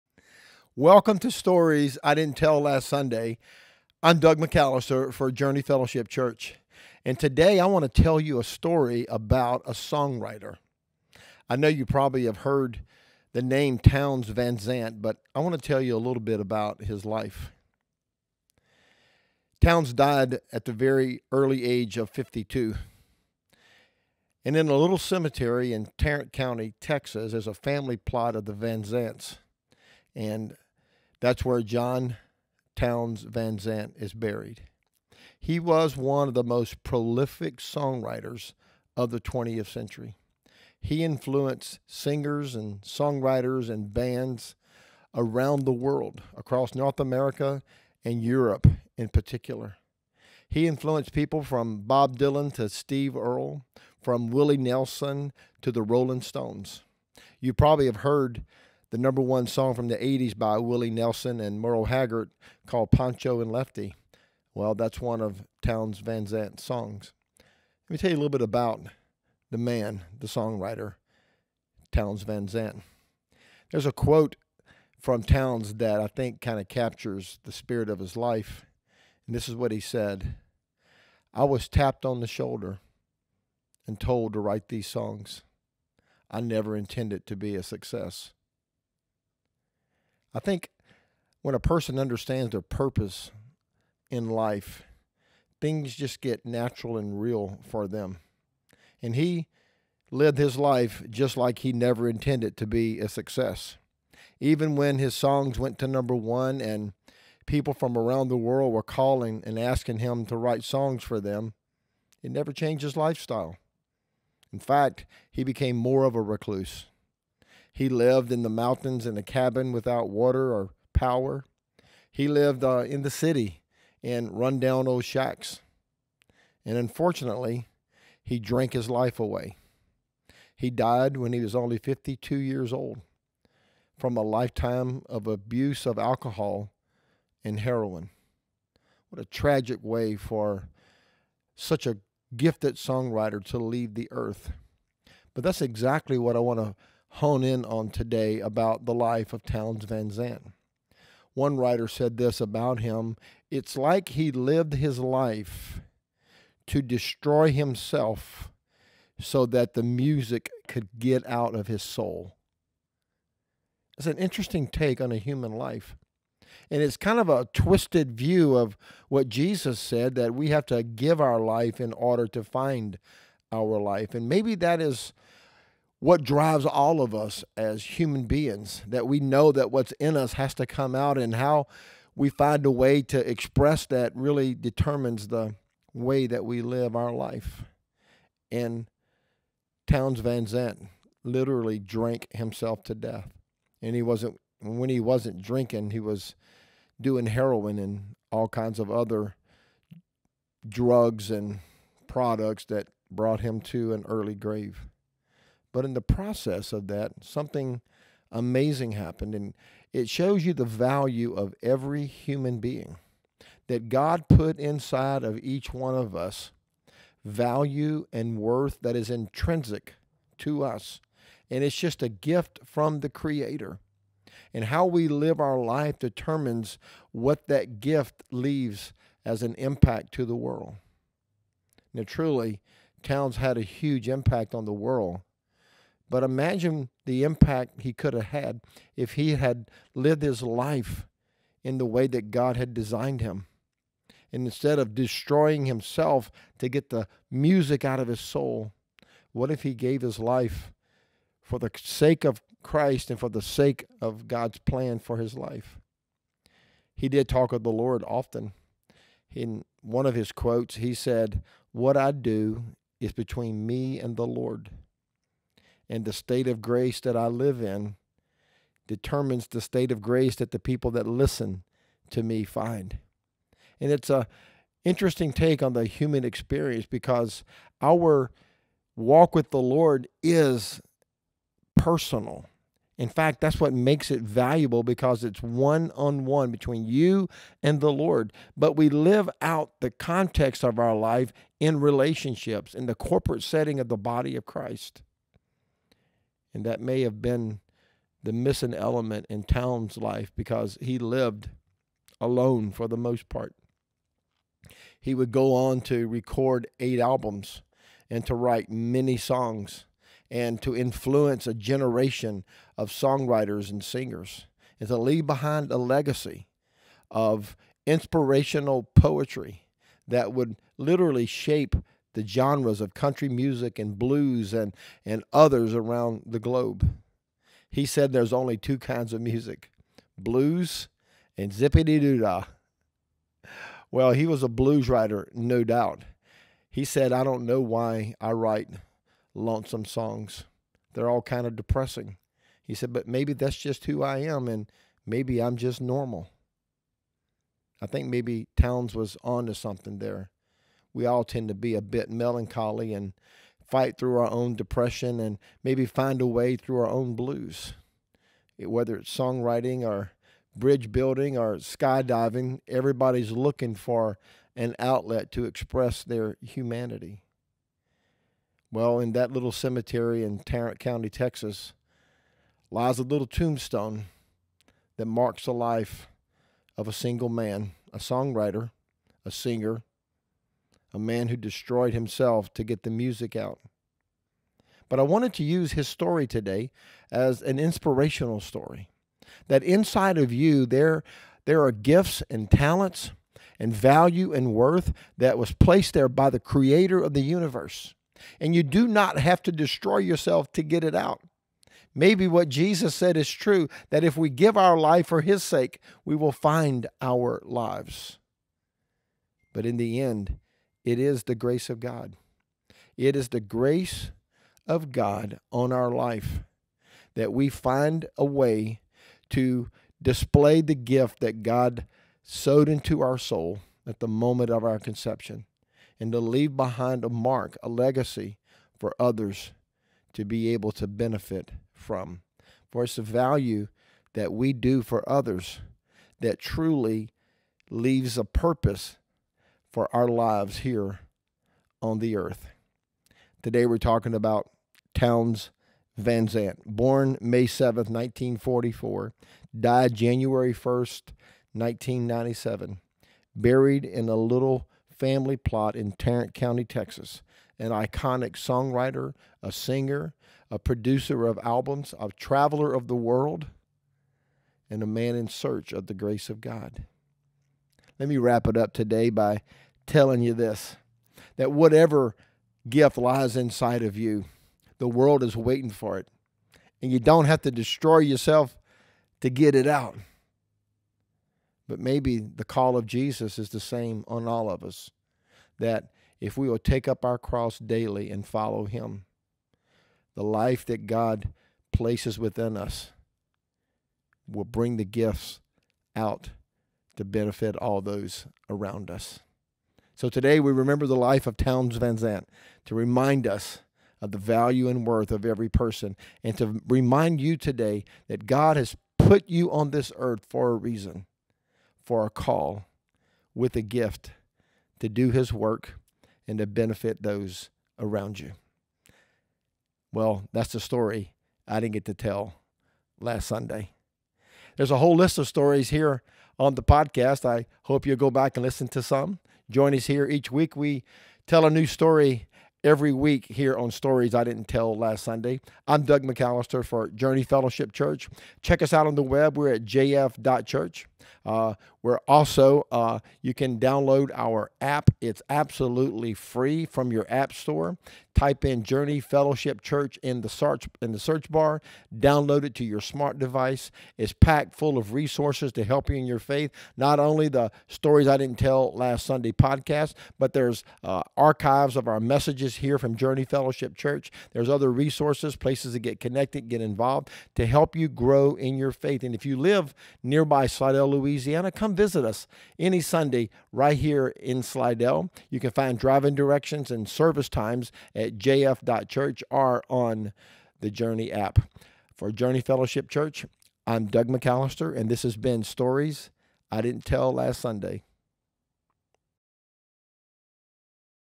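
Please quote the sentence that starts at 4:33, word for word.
And it's a interesting take on the human experience because our walk with the Lord is personal.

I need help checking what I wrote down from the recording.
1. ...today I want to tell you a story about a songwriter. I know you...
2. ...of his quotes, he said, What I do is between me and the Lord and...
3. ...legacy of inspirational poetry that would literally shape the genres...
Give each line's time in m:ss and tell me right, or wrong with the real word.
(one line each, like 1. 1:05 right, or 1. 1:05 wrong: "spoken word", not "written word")
1. 0:07 right
2. 4:20 right
3. 5:15 right.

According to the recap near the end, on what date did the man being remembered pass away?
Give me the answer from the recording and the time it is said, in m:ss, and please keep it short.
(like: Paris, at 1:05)
January 1, 1997, at 7:29.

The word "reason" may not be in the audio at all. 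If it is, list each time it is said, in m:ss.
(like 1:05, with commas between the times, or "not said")
8:30.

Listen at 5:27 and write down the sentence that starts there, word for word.
He said there's only two kinds of music blues and zippity doo dah.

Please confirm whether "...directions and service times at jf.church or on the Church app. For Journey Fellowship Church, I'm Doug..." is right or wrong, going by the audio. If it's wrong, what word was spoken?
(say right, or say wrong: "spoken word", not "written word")
wrong: "Journey", not "Church".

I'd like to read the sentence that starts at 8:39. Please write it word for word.
Well, that's the story I didn't get to tell last Sunday.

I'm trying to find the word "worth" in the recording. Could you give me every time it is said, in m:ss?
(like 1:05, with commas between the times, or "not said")
3:38, 6:34, 8:24.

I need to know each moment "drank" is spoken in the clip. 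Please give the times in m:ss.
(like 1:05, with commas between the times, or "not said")
2:08, 3:11.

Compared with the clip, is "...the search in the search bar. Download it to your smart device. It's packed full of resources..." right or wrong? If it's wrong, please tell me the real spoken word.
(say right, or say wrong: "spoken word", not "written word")
right.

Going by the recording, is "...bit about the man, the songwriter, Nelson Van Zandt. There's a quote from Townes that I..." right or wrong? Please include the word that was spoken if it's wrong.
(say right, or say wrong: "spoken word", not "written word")
wrong: "Townes", not "Nelson".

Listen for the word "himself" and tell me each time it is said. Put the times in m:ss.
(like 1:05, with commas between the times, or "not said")
2:37, 3:12, 4:05, 6:21.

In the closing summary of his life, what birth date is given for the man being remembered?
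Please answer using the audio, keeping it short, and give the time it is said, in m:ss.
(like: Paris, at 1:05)
May 7, 1944, at 7:27.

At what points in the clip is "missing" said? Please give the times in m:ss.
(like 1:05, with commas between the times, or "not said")
4:58.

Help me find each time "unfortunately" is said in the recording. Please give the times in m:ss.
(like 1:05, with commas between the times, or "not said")
2:06.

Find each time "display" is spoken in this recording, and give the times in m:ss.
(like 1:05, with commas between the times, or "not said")
7:00.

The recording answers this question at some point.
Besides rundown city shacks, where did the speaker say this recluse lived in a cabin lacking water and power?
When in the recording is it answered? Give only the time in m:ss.
1:58.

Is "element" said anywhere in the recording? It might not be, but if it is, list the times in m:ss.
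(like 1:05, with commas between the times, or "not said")
4:58.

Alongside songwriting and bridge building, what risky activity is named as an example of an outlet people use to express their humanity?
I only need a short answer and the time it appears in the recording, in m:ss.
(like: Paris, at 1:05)
Skydiving, at 6:01.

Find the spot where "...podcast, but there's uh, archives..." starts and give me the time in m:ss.
9:19.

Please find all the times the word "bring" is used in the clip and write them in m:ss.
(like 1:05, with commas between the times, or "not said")
8:14.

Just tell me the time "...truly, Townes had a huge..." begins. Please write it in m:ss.
3:52.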